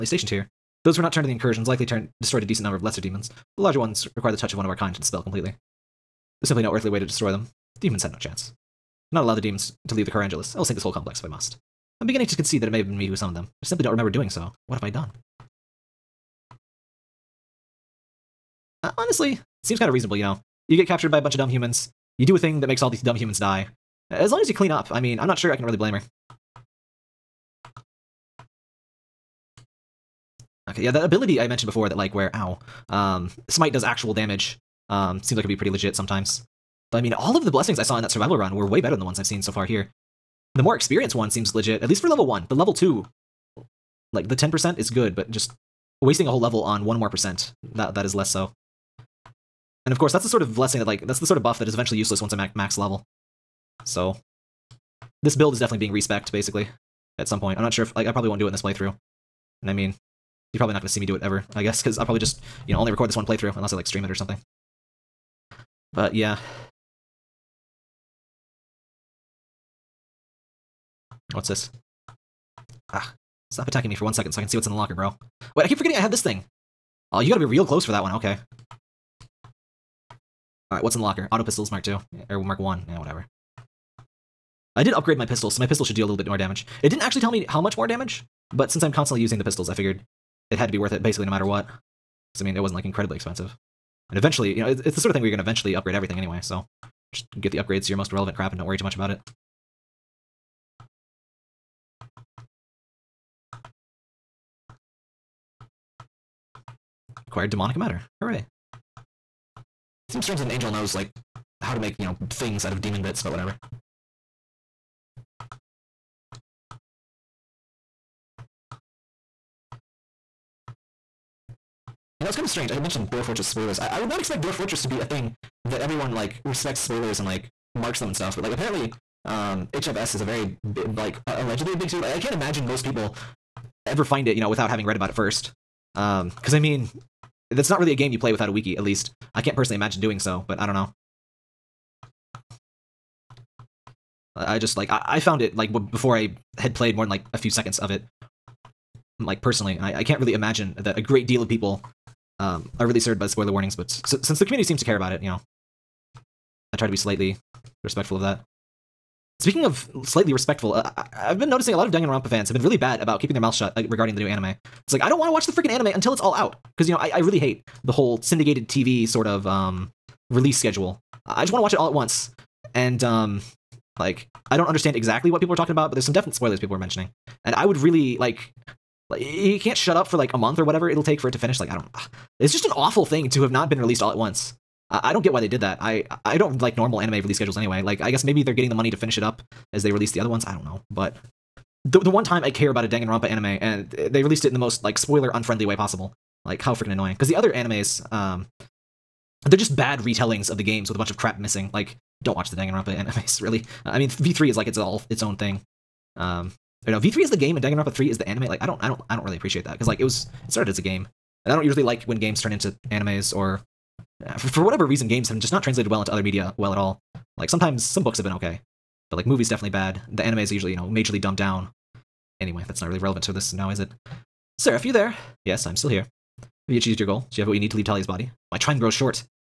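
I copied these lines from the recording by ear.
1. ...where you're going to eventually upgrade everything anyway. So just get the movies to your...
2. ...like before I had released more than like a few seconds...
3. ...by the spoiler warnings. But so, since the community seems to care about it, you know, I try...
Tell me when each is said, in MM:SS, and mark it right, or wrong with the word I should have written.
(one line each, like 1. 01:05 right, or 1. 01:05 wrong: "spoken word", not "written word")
1. 01:35 wrong: "upgrades", not "movies"
2. 02:25 wrong: "played", not "released"
3. 02:33 right.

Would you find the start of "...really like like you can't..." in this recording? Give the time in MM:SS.
02:57.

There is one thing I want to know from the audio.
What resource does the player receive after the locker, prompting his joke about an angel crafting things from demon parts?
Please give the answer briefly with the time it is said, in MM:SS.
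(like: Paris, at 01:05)
demonic matter, at 01:47.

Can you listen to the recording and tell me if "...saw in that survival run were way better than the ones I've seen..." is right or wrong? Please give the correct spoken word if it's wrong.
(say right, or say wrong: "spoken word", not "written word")
right.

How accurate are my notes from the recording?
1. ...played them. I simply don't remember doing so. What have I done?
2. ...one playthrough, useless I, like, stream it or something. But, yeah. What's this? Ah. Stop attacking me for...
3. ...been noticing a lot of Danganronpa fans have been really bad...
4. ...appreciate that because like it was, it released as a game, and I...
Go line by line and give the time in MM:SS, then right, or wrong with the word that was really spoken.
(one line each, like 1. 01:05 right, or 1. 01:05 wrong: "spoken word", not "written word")
1. 00:13 wrong: "summoned", not "played"
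2. 01:03 wrong: "unless", not "useless"
3. 02:41 right
4. 03:29 wrong: "started", not "released".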